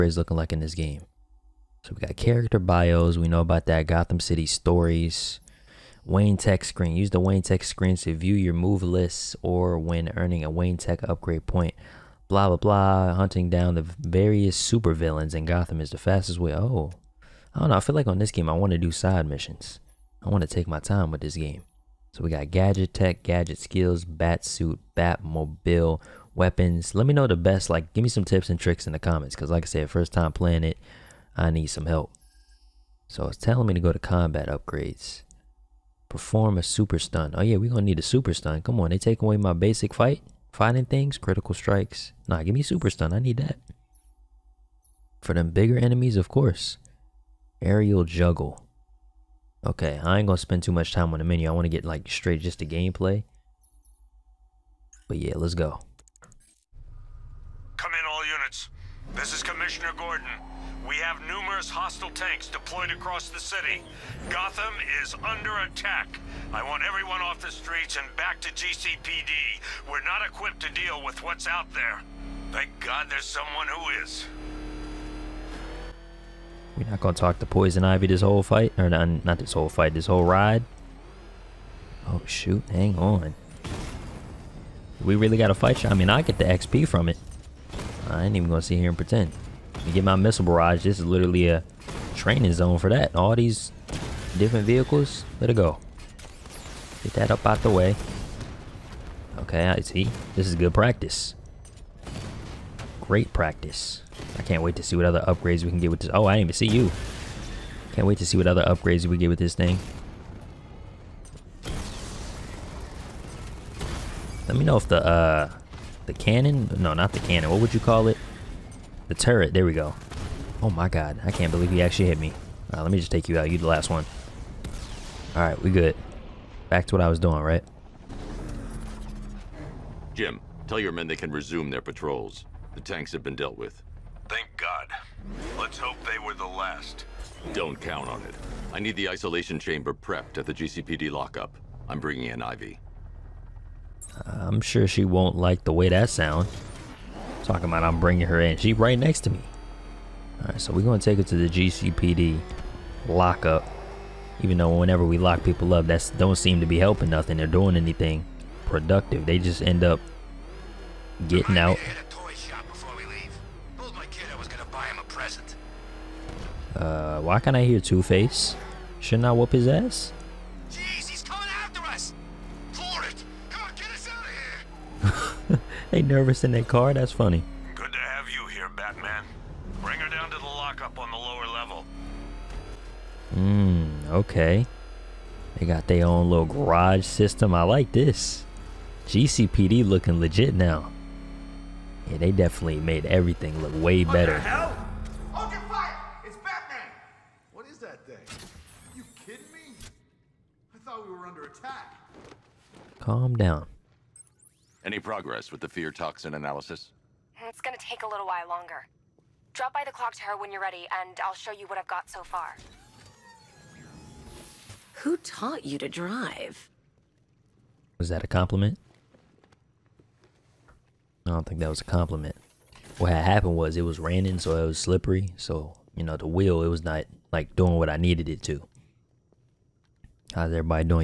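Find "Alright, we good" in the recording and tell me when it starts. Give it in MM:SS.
02:05.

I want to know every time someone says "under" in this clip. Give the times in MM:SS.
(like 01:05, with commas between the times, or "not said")
01:05, 03:21.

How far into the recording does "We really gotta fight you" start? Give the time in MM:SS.
01:25.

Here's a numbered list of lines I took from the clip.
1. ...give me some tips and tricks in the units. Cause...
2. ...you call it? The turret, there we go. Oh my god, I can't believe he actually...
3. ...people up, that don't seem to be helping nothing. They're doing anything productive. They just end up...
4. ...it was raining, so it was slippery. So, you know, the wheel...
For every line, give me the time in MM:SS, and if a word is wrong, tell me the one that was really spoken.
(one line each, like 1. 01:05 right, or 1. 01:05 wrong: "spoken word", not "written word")
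1. 00:27 wrong: "comments", not "units"
2. 01:57 right
3. 02:35 right
4. 03:43 right.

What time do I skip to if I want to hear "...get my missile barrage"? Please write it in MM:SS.
01:29.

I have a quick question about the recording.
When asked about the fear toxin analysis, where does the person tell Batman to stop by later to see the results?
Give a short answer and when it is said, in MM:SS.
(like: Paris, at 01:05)
The clock tower, at 03:29.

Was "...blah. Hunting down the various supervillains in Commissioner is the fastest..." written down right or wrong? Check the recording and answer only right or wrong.
wrong.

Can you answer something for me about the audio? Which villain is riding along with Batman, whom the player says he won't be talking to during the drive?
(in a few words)
Poison Ivy.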